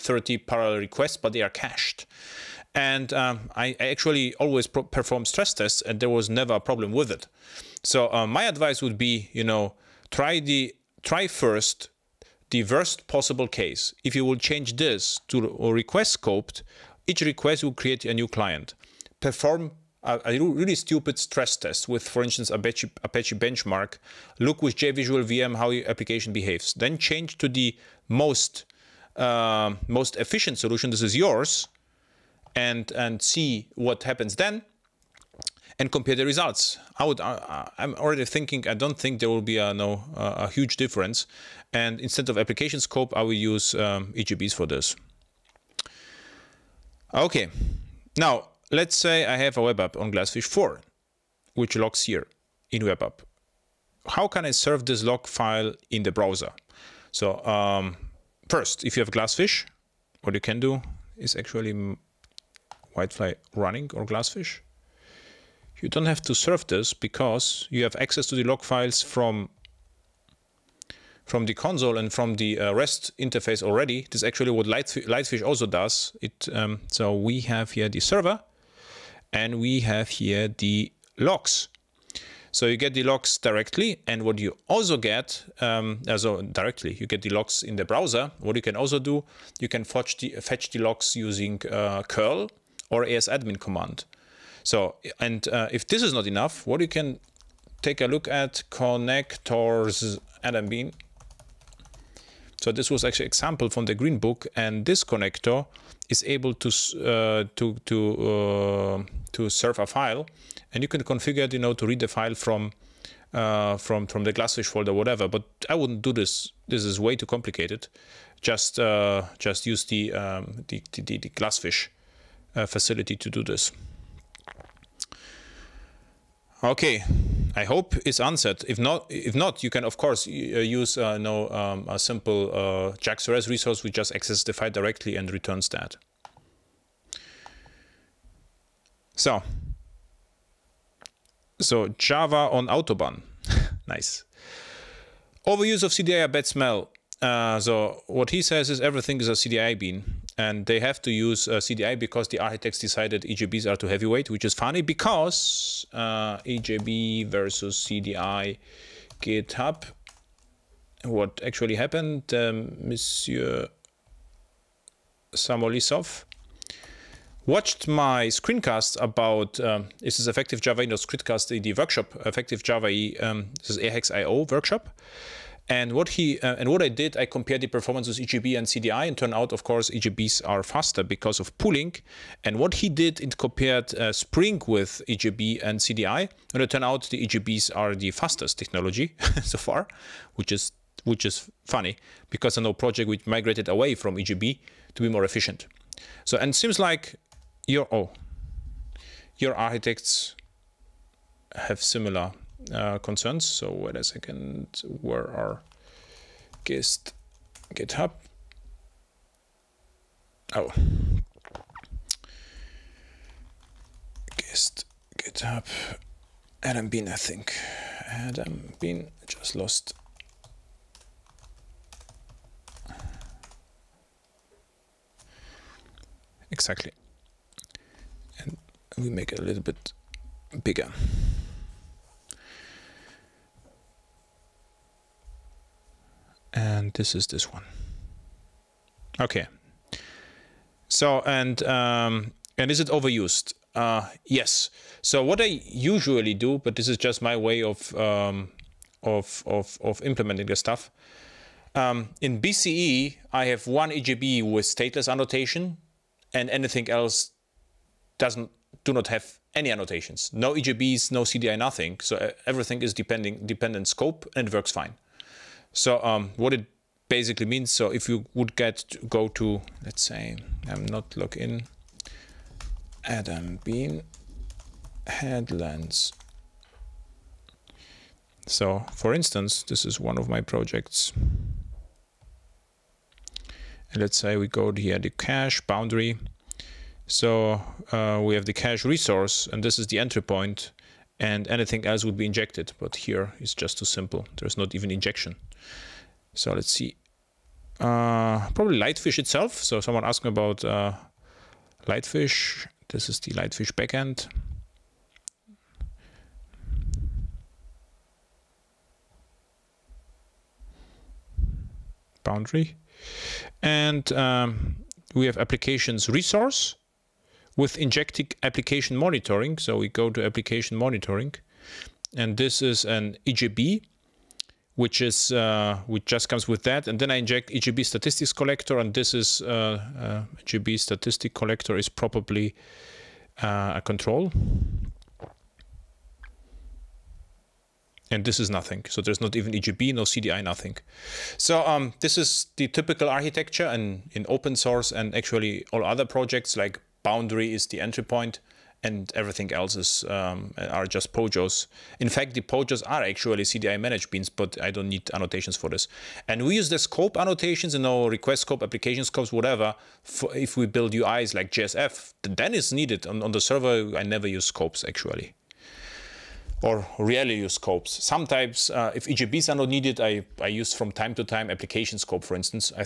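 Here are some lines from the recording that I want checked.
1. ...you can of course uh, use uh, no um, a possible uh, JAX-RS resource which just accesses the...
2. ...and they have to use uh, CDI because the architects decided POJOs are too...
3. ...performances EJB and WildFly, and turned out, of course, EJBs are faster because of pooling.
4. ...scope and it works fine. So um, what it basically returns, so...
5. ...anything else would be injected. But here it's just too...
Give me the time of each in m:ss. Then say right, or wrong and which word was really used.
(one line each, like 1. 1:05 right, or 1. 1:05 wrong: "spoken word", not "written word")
1. 2:09 wrong: "simple", not "possible"
2. 2:30 wrong: "EJBs", not "POJOs"
3. 2:57 wrong: "CDI", not "WildFly"
4. 4:23 wrong: "means", not "returns"
5. 4:51 right.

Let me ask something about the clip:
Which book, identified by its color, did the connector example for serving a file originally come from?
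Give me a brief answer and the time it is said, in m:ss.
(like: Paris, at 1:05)
the green book, at 1:43.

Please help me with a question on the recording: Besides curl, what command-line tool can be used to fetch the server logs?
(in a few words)
asadmin.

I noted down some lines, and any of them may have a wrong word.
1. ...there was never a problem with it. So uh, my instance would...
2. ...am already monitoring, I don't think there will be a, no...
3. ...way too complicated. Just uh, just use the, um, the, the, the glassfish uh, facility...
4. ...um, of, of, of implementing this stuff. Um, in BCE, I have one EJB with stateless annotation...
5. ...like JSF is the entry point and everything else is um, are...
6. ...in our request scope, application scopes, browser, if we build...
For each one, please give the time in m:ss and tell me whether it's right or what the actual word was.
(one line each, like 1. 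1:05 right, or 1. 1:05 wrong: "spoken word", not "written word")
1. 0:05 wrong: "advice", not "instance"
2. 0:37 wrong: "thinking", not "monitoring"
3. 1:56 right
4. 4:07 right
5. 5:46 wrong: "Boundary", not "JSF"
6. 5:57 wrong: "whatever", not "browser".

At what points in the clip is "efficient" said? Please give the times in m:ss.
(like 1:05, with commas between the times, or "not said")
0:30, 3:15.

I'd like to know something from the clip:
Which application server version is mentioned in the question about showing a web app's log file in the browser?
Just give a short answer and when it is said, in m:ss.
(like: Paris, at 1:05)
Glassfish 4, at 0:50.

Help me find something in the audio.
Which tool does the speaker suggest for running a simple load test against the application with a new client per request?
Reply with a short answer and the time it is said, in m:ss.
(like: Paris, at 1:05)
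Apache Benchmark, at 0:23.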